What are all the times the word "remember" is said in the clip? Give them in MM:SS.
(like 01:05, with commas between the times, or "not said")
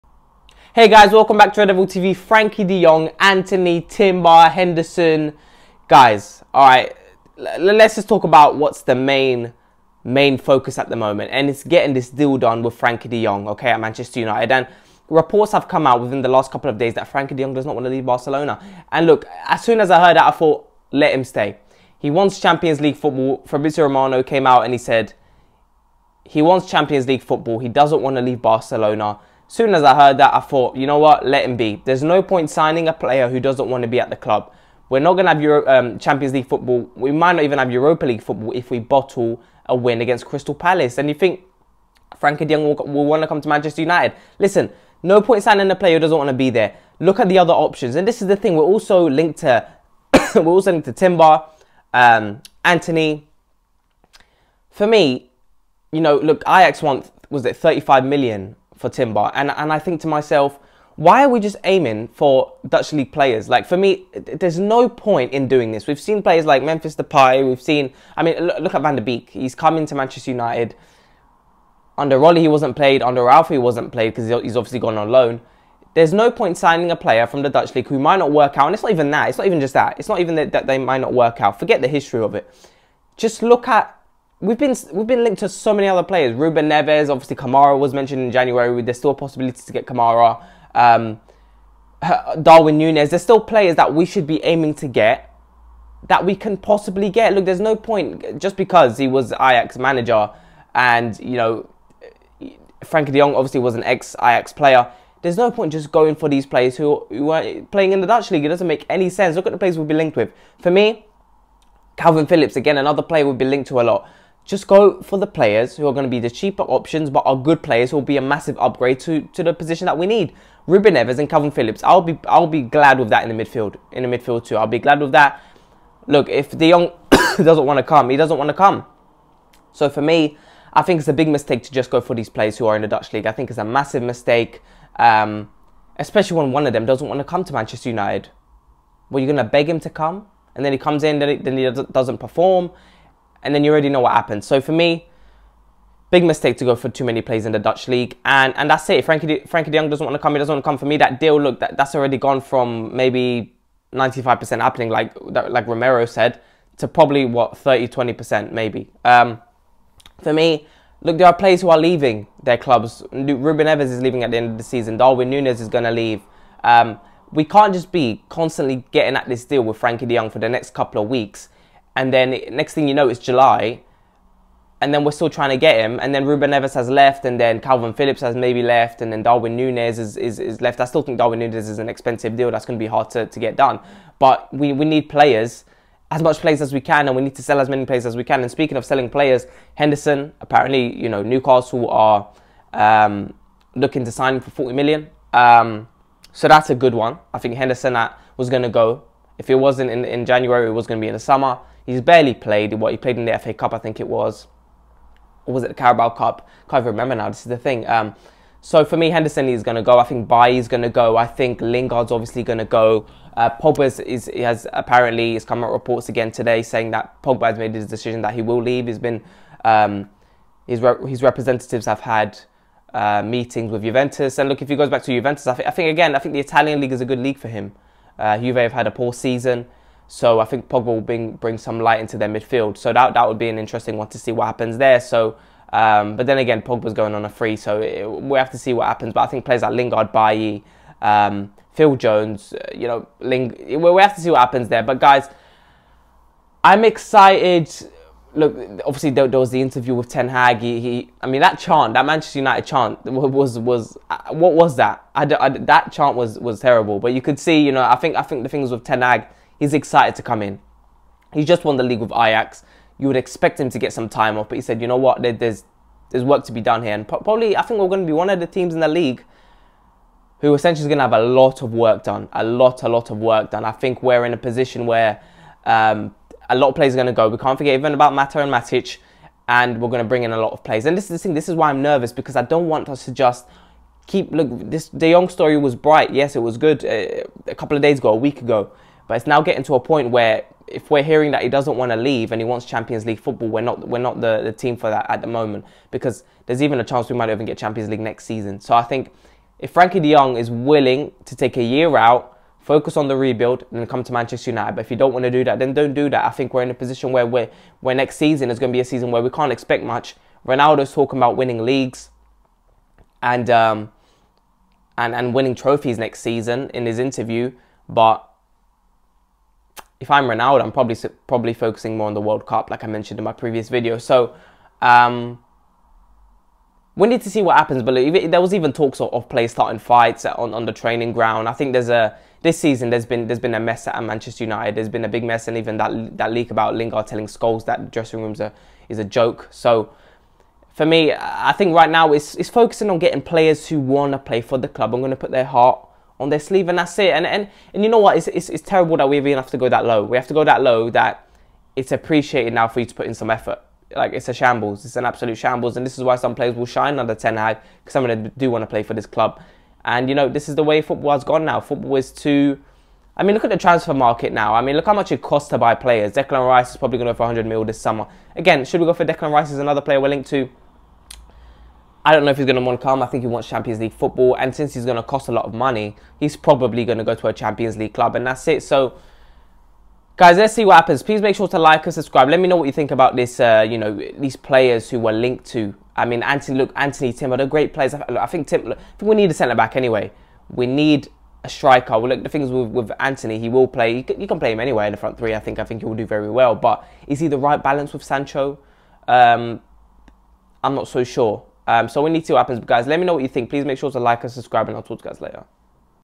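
03:26.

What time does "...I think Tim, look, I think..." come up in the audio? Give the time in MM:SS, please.
06:28.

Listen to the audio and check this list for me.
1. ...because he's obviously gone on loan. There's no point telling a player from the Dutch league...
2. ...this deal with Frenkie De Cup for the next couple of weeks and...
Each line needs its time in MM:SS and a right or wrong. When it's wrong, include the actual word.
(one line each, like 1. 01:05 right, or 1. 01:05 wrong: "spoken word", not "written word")
1. 01:14 wrong: "signing", not "telling"
2. 02:49 wrong: "Jong", not "Cup".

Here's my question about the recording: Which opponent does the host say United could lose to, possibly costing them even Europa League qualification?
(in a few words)
Crystal Palace.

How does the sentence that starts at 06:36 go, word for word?
But is he the right balance with Sancho?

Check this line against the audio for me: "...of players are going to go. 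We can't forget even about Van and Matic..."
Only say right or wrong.
wrong.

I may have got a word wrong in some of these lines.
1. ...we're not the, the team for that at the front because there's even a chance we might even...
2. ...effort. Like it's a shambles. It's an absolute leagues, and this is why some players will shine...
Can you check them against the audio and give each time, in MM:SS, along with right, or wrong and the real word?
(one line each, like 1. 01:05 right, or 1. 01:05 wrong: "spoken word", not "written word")
1. 04:53 wrong: "moment", not "front"
2. 05:53 wrong: "shambles", not "leagues".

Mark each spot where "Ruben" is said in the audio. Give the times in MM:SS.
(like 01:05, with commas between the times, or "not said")
01:26, 02:00, 02:43, 02:56.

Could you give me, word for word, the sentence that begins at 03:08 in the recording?
And speaking of selling players, Henderson, apparently, you know, Newcastle are um, looking to sign him for 40 million.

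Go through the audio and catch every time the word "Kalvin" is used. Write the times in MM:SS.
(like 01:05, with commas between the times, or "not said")
01:51, 02:01, 02:57.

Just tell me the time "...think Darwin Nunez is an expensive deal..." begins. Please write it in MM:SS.
03:01.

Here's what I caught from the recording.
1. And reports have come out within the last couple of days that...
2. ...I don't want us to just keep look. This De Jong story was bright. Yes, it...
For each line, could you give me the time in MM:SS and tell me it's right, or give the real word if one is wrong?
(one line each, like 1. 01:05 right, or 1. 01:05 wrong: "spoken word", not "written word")
1. 00:14 right
2. 04:42 right.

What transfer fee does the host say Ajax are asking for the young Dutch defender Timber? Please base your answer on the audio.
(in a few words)
35 million.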